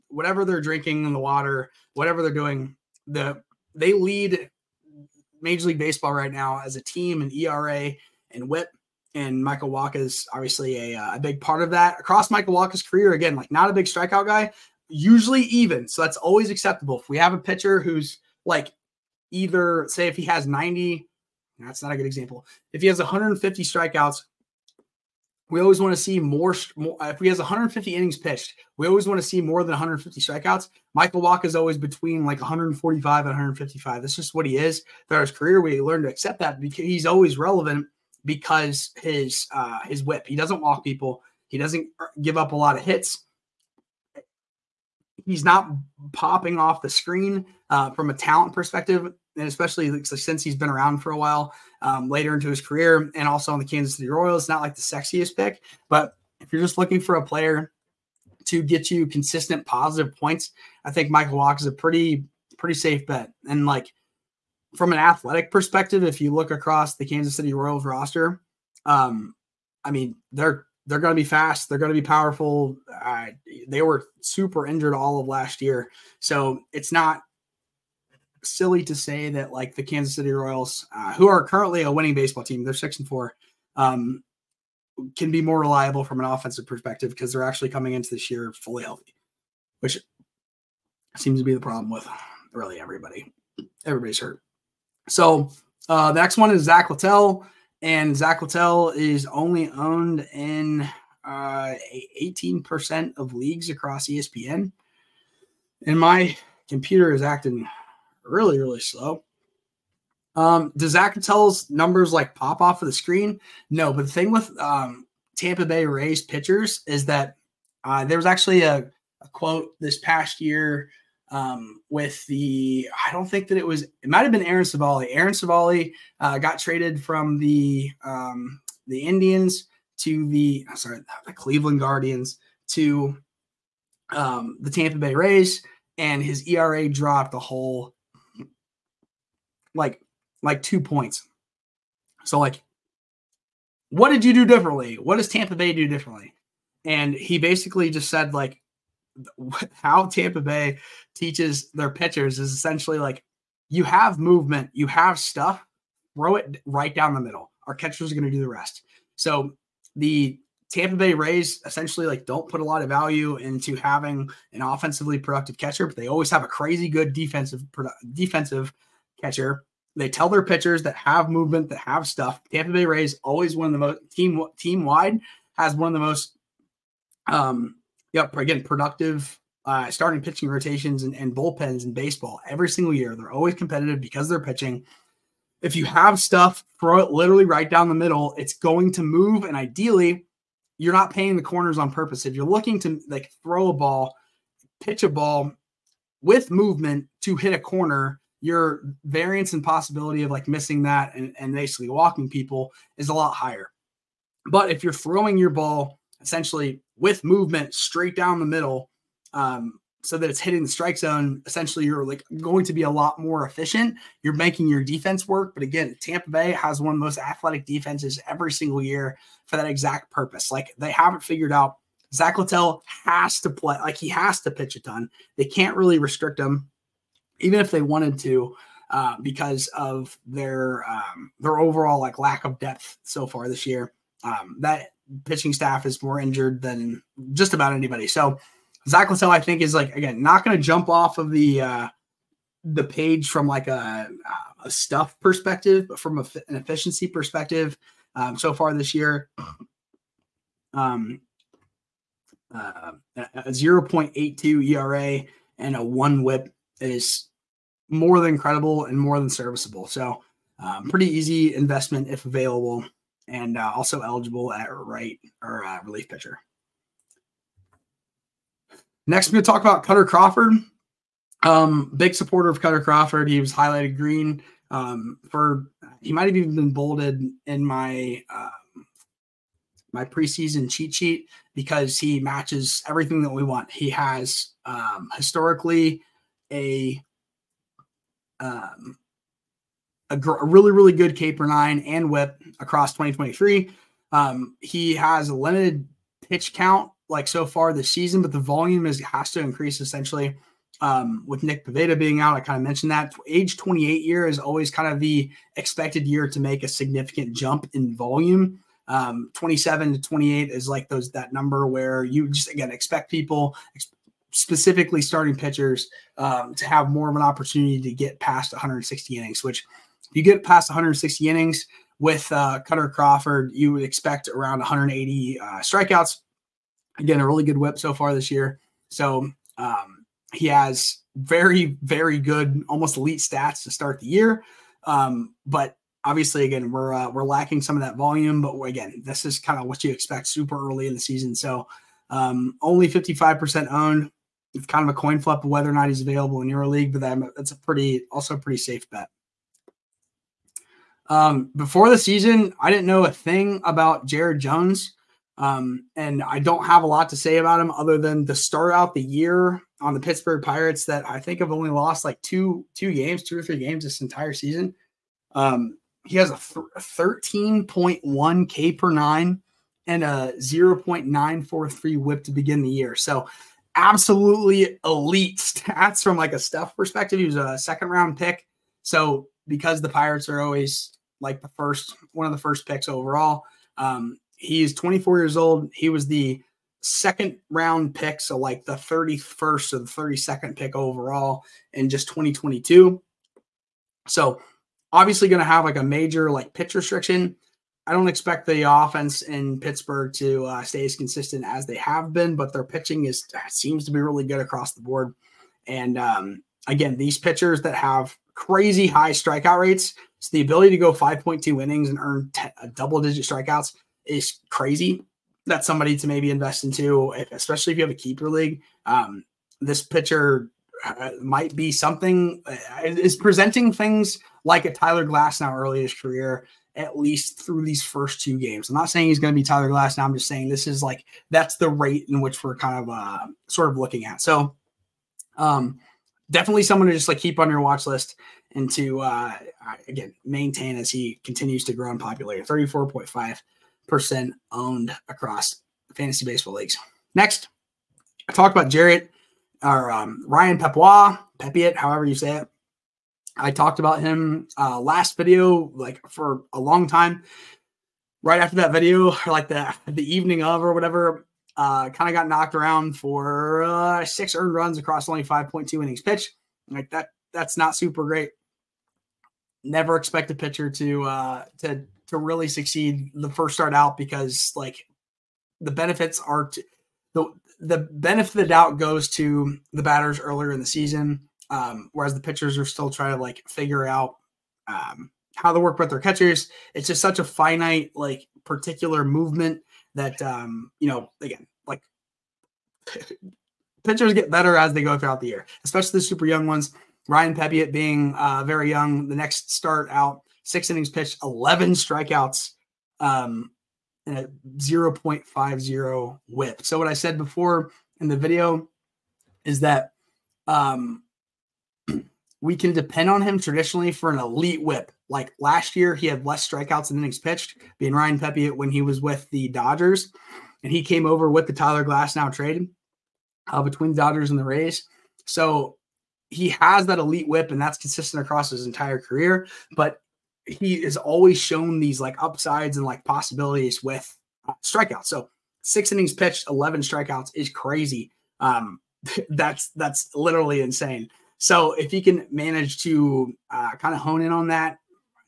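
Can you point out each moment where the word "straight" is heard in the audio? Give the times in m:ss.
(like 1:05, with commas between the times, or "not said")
3:27.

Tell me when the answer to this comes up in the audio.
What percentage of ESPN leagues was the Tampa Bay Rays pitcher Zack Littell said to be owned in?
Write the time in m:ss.
1:42.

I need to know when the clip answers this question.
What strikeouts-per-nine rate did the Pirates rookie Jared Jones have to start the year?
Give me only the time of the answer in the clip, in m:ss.
6:06.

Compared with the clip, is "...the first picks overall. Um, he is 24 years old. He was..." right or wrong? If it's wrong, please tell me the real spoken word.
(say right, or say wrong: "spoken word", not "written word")
right.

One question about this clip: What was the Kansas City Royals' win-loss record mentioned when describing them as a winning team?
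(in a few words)
6 and 4.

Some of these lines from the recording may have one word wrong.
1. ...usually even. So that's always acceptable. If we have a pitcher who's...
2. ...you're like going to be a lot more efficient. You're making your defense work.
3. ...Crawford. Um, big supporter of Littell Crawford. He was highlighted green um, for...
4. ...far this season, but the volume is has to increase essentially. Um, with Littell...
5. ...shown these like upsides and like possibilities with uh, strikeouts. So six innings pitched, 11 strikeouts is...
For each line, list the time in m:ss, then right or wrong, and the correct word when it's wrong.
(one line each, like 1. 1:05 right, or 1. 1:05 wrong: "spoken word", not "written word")
1. 0:14 right
2. 3:31 right
3. 4:30 wrong: "Kutter", not "Littell"
4. 4:57 wrong: "Nick", not "Littell"
5. 8:51 right.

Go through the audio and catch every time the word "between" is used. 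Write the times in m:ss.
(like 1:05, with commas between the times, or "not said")
0:31, 8:43.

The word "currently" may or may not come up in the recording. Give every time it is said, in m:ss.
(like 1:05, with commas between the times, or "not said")
1:21.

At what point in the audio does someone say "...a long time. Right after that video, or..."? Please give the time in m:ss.
7:36.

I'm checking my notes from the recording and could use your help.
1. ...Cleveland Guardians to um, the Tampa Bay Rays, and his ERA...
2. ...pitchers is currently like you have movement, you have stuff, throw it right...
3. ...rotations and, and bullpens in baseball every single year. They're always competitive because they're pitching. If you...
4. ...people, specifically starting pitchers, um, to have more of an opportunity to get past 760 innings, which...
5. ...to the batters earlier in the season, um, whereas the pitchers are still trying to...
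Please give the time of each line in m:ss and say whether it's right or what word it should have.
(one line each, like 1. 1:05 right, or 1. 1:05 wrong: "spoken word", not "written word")
1. 2:11 right
2. 2:31 wrong: "essentially", not "currently"
3. 3:00 right
4. 5:13 wrong: "160", not "760"
5. 7:59 right.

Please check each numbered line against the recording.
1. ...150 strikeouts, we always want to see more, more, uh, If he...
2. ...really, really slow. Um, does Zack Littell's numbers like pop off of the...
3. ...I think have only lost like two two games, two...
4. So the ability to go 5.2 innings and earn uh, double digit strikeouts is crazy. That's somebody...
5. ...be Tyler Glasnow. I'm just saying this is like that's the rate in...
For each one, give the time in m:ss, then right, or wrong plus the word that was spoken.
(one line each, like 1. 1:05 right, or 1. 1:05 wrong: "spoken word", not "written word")
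1. 0:22 right
2. 1:48 right
3. 6:01 right
4. 6:50 right
5. 7:09 right.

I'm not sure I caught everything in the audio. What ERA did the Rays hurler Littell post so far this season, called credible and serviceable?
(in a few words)
0.82.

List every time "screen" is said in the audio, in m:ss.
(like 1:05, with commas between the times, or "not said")
0:46, 1:52.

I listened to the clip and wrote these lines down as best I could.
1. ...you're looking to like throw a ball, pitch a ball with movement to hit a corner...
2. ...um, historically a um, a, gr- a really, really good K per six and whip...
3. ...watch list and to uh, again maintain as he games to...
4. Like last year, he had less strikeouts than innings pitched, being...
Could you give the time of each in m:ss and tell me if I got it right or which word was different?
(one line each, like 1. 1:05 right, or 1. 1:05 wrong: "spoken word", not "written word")
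1. 3:12 right
2. 4:44 wrong: "nine", not "six"
3. 7:17 wrong: "continues", not "games"
4. 8:35 right.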